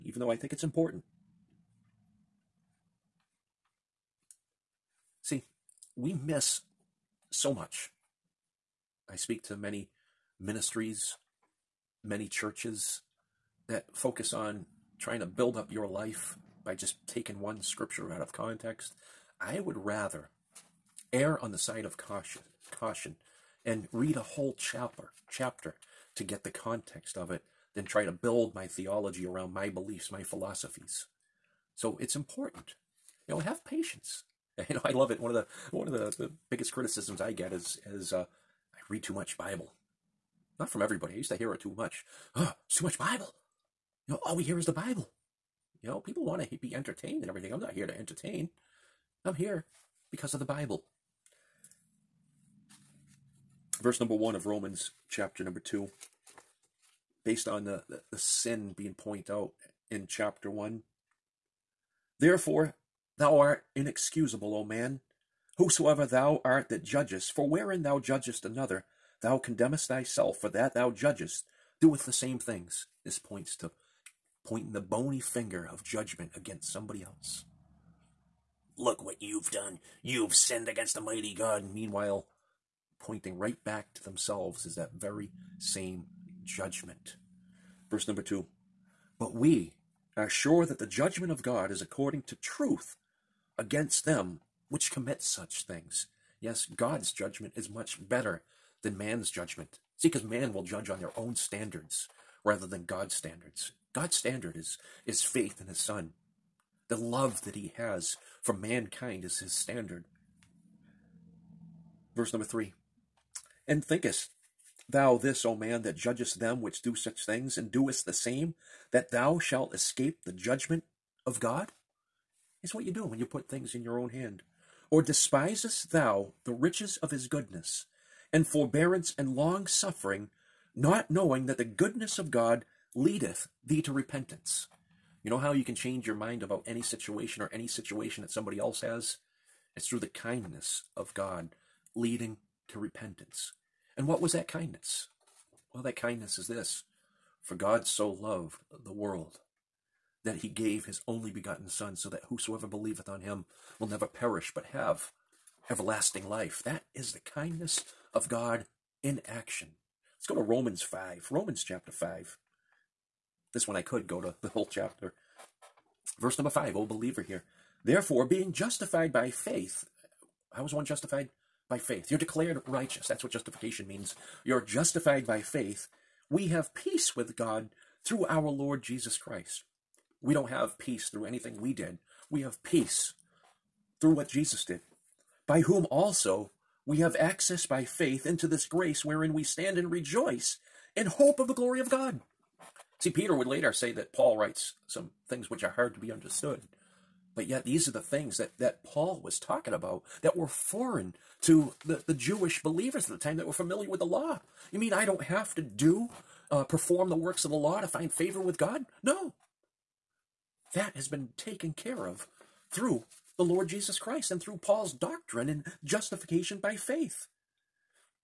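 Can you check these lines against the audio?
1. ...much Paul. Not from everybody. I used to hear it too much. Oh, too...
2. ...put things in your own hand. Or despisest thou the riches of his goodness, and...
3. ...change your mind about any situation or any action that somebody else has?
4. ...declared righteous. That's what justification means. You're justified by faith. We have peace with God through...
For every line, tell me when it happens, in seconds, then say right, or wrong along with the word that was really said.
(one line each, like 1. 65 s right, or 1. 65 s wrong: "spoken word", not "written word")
1. 39 s wrong: "Bible", not "Paul"
2. 123 s right
3. 135 s wrong: "situation", not "action"
4. 172 s right.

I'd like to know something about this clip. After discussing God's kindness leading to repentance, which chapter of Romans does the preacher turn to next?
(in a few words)
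Romans 5.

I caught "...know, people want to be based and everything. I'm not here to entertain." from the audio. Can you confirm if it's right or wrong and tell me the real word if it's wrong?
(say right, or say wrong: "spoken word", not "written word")
wrong: "entertained", not "based".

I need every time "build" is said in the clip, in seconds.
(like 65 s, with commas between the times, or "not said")
15 s, 28 s.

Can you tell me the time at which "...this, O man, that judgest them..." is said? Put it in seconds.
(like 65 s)
115 s.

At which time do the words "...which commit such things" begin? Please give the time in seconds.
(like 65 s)
94 s.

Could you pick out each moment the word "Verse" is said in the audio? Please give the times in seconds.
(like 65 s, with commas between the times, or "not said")
53 s, 87 s, 112 s, 166 s.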